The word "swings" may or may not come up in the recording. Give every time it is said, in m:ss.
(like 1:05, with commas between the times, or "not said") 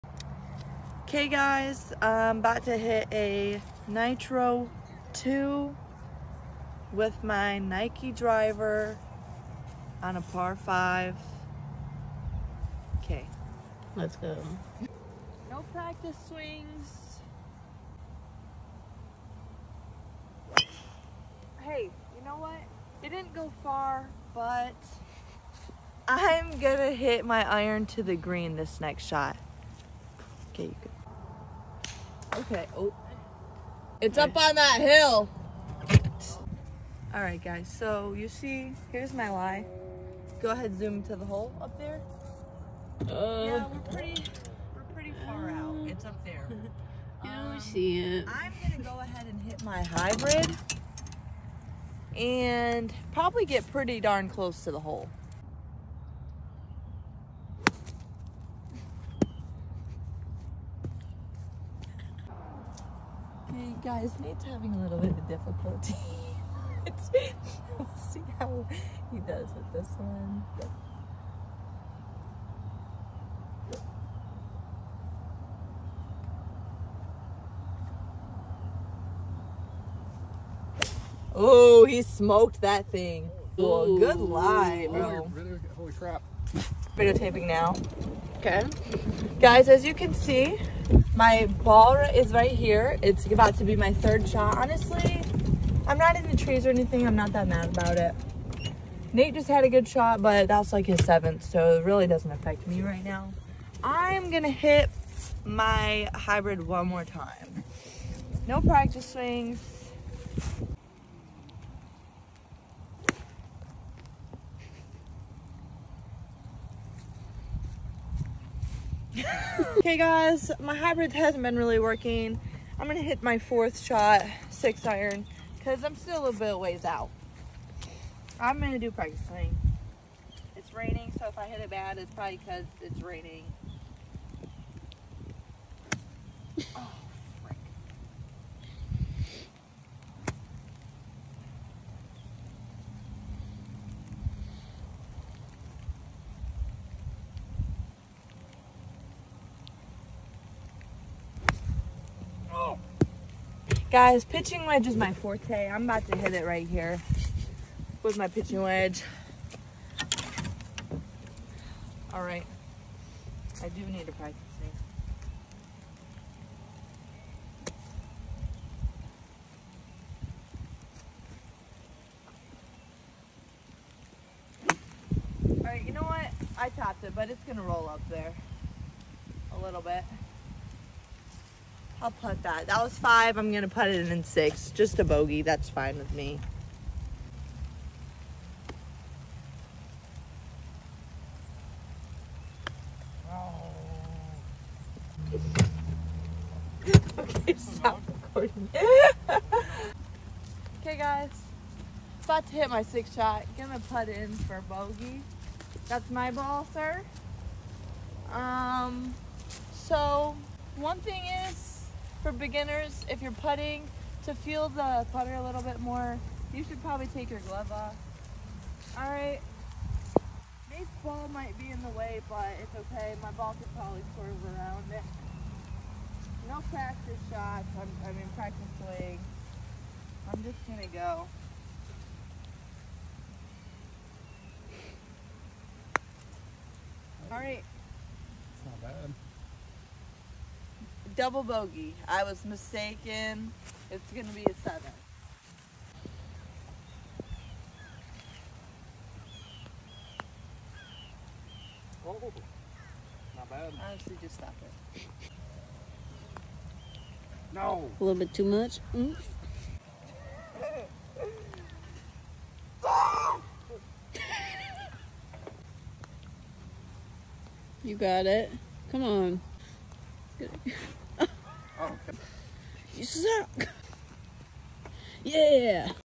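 0:16, 1:49, 3:48.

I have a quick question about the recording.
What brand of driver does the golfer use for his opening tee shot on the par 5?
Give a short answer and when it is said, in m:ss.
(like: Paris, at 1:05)
Nike, at 0:07.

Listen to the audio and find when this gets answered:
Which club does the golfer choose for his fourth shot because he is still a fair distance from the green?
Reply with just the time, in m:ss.
2:04.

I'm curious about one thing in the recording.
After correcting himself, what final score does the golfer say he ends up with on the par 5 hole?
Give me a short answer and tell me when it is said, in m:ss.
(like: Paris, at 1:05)
7, at 4:04.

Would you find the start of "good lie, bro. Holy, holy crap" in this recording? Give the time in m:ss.
1:23.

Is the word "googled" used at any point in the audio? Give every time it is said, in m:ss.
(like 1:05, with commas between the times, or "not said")
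not said.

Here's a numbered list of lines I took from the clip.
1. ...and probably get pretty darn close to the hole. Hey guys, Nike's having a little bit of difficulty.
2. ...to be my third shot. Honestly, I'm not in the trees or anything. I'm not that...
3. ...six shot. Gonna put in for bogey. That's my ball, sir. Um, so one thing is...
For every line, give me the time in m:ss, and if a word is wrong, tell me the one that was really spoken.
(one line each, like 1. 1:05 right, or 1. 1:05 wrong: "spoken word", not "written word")
1. 0:52 wrong: "Nate", not "Nike"
2. 1:33 right
3. 3:22 right.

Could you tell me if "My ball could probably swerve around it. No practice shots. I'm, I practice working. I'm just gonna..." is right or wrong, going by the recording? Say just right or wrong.
wrong.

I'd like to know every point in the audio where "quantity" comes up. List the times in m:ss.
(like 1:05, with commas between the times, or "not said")
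not said.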